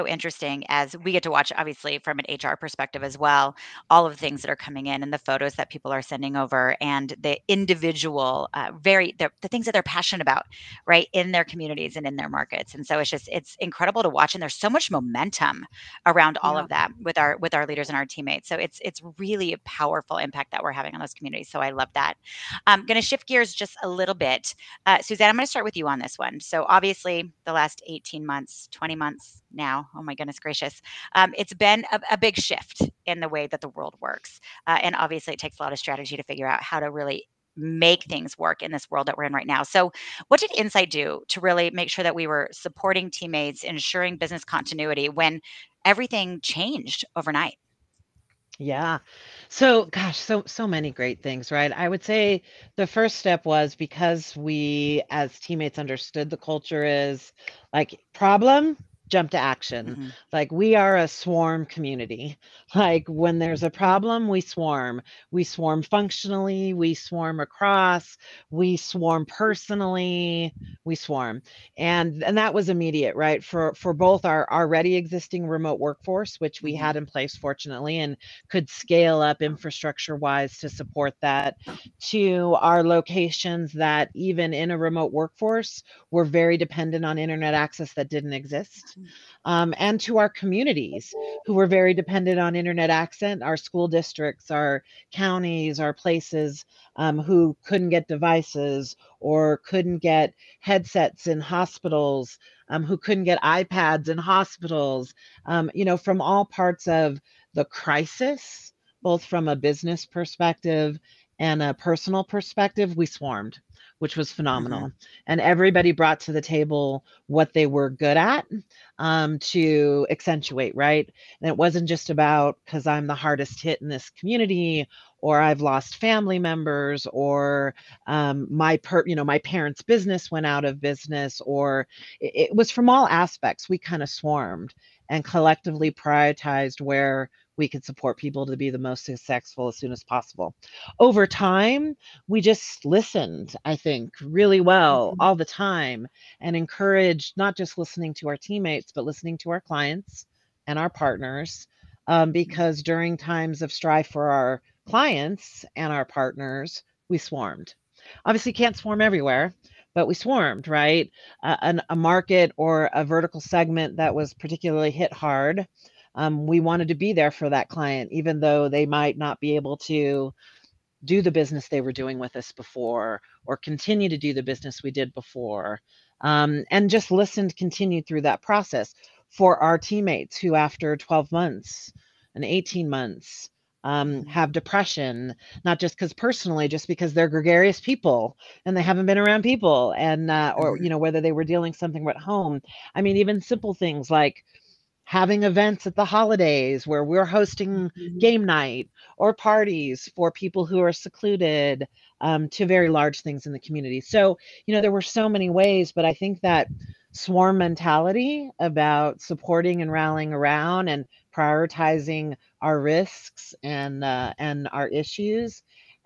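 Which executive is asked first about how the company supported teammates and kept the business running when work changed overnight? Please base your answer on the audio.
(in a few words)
Suzanne.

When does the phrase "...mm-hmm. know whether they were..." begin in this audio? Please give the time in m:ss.
3:10.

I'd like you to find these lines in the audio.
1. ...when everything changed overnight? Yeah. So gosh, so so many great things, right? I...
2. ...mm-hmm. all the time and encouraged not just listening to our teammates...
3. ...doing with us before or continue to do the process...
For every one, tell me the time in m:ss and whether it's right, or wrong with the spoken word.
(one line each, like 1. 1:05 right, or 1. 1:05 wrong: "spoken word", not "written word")
1. 0:45 right
2. 2:25 right
3. 2:51 wrong: "business", not "process".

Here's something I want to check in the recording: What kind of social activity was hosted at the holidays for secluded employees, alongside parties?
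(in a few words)
Game night.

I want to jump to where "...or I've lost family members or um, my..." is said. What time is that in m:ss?
2:05.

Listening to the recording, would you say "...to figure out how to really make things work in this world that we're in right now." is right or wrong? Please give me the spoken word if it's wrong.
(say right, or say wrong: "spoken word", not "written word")
right.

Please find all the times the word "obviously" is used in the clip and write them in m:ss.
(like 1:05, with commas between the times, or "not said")
0:01, 0:26, 0:34, 2:38.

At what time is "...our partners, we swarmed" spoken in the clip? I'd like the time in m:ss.
2:35.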